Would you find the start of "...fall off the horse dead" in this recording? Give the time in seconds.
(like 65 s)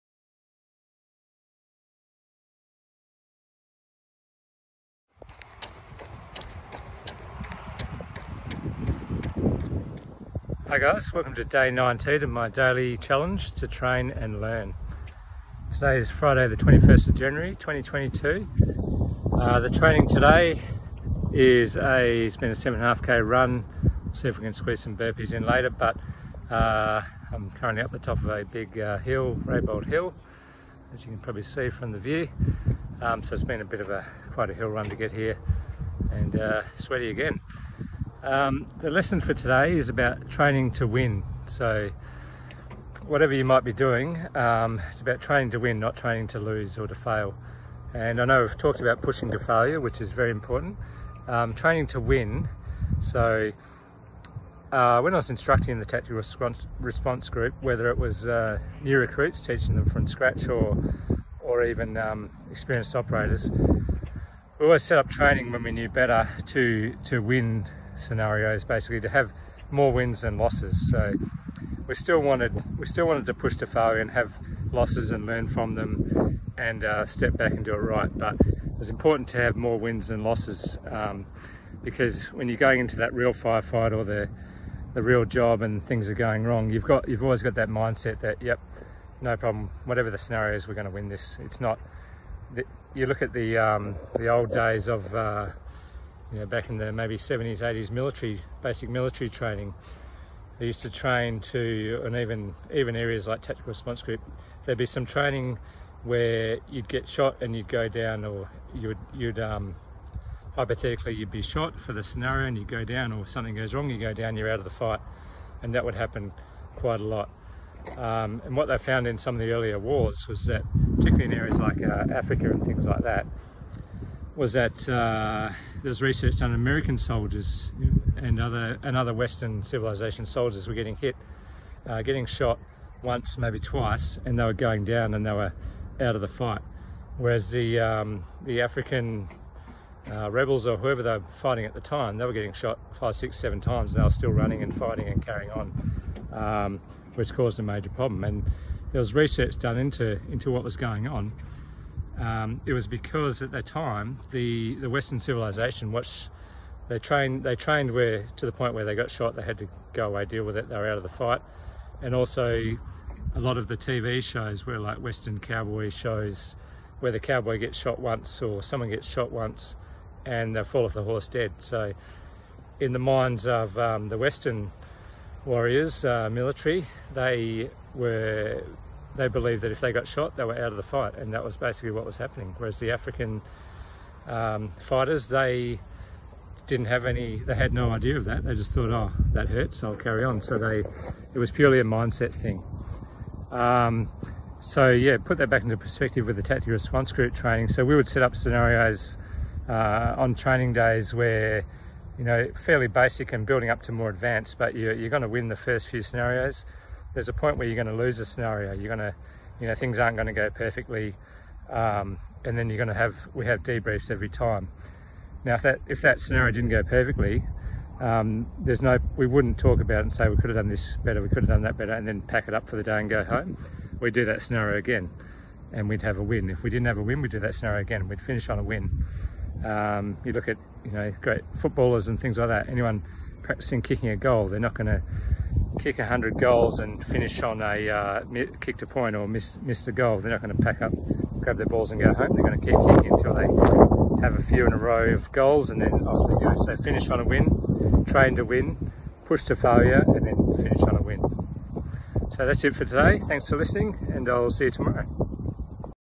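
170 s.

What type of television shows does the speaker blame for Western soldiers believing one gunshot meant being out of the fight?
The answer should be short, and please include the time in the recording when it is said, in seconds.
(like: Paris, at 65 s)
Western cowboy shows, at 165 s.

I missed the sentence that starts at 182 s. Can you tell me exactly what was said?
Whereas the African um, fighters, they didn't have any, they had no idea of that.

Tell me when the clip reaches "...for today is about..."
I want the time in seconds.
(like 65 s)
39 s.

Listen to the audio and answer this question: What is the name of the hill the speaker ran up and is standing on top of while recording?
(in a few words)
Raybold Hill.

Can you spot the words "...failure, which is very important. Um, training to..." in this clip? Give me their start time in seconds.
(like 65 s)
49 s.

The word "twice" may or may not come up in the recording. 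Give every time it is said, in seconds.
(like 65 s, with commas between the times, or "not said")
133 s.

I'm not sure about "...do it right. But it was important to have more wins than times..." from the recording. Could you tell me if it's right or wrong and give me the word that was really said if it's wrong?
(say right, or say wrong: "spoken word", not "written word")
wrong: "losses", not "times".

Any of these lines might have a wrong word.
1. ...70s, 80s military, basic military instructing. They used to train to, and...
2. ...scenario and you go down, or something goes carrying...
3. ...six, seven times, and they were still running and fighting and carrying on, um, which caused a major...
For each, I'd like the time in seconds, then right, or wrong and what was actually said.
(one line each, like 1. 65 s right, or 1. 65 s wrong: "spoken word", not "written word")
1. 97 s wrong: "training", not "instructing"
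2. 112 s wrong: "wrong", not "carrying"
3. 143 s right.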